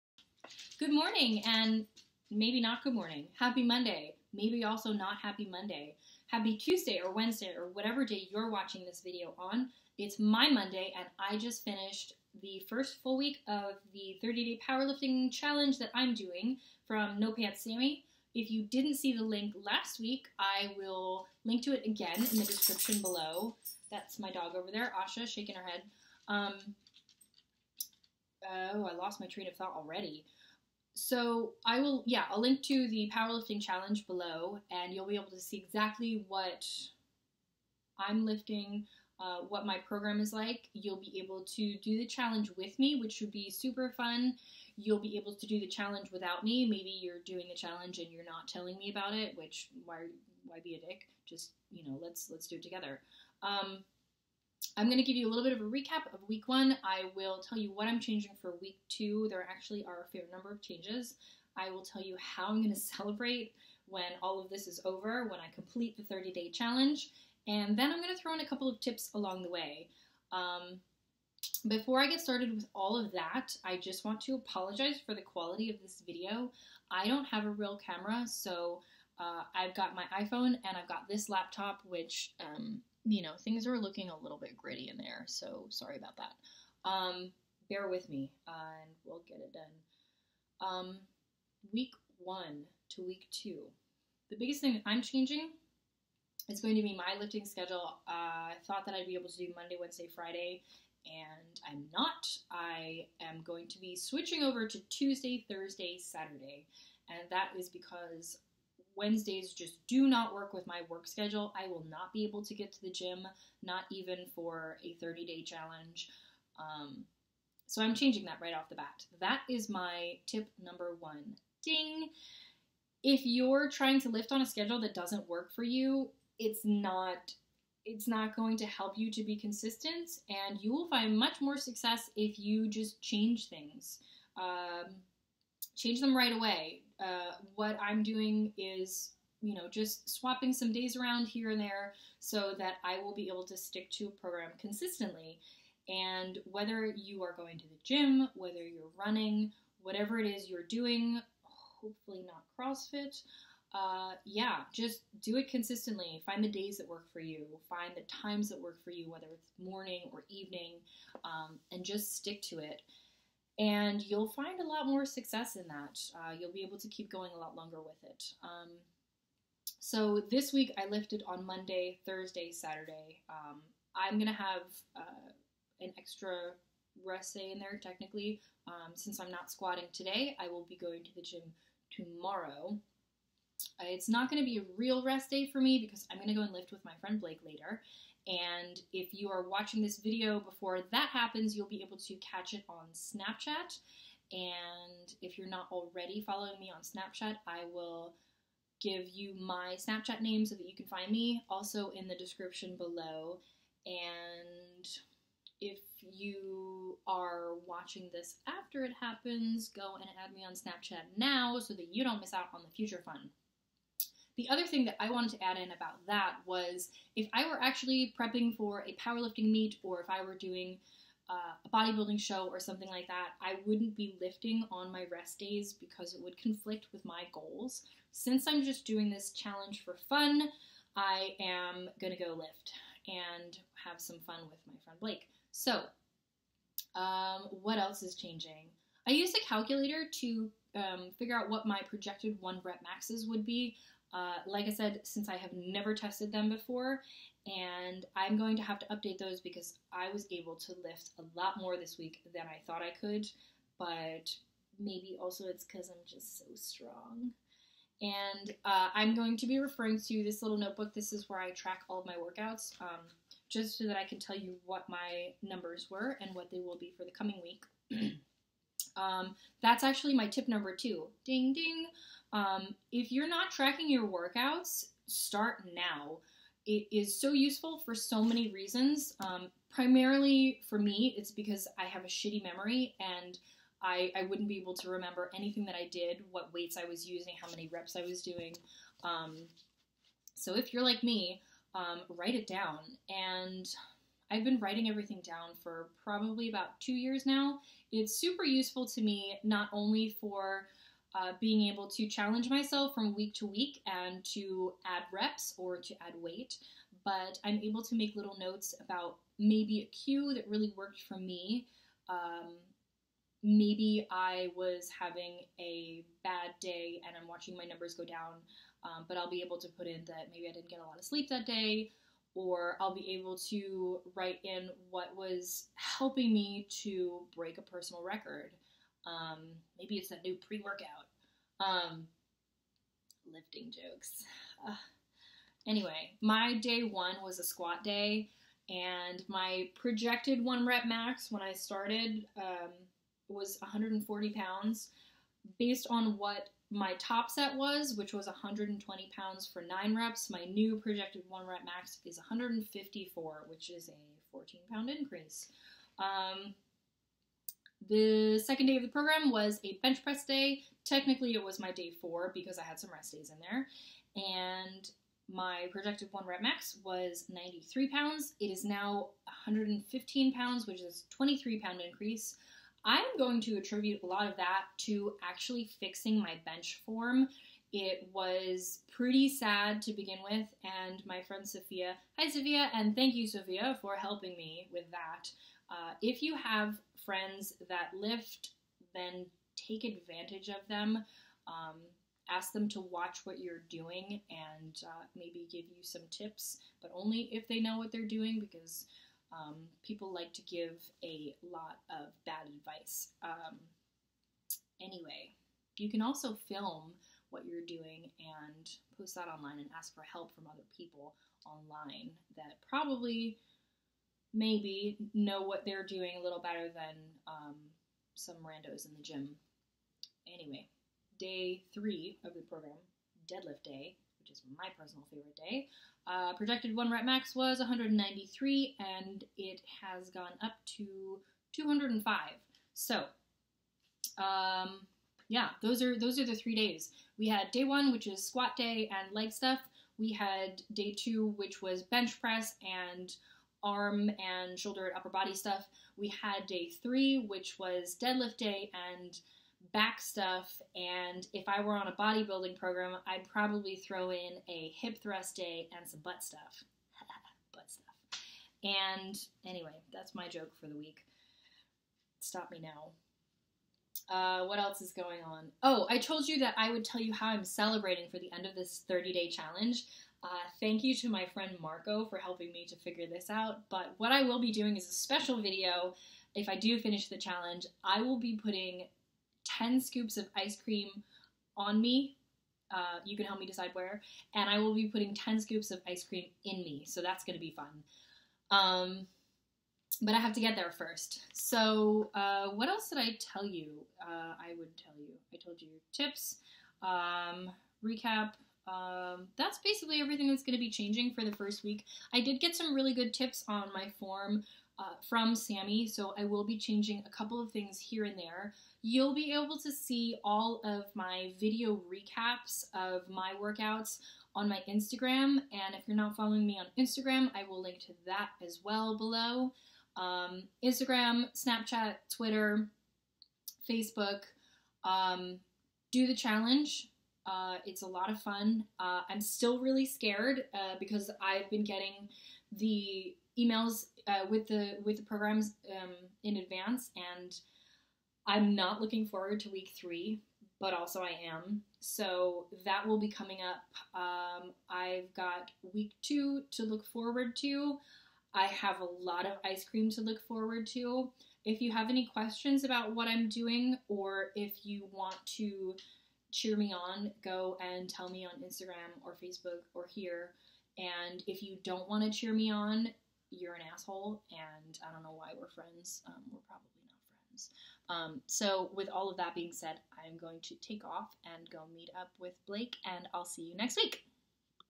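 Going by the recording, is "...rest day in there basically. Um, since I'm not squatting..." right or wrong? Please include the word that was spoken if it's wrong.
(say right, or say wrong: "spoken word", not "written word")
wrong: "technically", not "basically".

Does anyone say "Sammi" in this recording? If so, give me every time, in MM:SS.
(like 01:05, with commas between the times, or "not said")
00:17, 08:25.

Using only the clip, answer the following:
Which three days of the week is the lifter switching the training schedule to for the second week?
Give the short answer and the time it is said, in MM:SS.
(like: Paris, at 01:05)
Tuesday, Thursday, Saturday, at 01:44.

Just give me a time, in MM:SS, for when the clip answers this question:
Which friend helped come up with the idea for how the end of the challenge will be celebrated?
07:51.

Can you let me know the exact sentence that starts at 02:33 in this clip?
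Uh, yeah, just do it consistently.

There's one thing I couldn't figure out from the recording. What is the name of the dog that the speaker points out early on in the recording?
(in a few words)
Asha.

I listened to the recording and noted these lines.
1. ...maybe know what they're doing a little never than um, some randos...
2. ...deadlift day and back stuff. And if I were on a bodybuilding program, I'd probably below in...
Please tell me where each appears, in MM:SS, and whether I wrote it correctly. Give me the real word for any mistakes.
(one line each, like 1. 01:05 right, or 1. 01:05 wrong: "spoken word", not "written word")
1. 06:54 wrong: "better", not "never"
2. 07:28 wrong: "throw", not "below".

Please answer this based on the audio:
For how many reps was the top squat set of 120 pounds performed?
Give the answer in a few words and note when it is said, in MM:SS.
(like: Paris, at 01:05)
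9, at 05:49.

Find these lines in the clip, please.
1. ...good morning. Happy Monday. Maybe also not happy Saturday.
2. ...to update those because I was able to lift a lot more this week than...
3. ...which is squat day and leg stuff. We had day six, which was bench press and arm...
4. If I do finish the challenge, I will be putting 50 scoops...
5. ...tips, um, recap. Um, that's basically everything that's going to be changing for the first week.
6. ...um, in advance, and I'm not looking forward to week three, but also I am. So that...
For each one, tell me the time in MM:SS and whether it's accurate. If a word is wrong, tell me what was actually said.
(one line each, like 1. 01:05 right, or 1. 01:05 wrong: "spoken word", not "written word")
1. 00:02 wrong: "Monday", not "Saturday"
2. 04:08 right
3. 07:17 wrong: "two", not "six"
4. 07:56 wrong: "10", not "50"
5. 08:15 right
6. 08:55 right.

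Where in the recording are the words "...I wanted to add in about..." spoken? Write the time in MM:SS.
03:34.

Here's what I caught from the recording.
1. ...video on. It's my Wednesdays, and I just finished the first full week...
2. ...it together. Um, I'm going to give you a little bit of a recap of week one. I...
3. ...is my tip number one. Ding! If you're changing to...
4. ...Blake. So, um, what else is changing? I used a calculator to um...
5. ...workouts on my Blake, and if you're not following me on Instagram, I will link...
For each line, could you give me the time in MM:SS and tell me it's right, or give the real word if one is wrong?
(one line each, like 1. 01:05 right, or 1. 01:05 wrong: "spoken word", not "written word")
1. 00:09 wrong: "Monday", not "Wednesdays"
2. 00:52 right
3. 01:59 wrong: "trying", not "changing"
4. 03:54 right
5. 08:33 wrong: "Instagram", not "Blake".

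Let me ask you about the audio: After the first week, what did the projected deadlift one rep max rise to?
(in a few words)
205.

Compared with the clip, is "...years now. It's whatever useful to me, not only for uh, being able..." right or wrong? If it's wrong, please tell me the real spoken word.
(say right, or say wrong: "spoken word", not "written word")
wrong: "super", not "whatever".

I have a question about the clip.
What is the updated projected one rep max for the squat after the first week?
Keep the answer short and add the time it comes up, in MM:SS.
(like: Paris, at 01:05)
154, at 05:52.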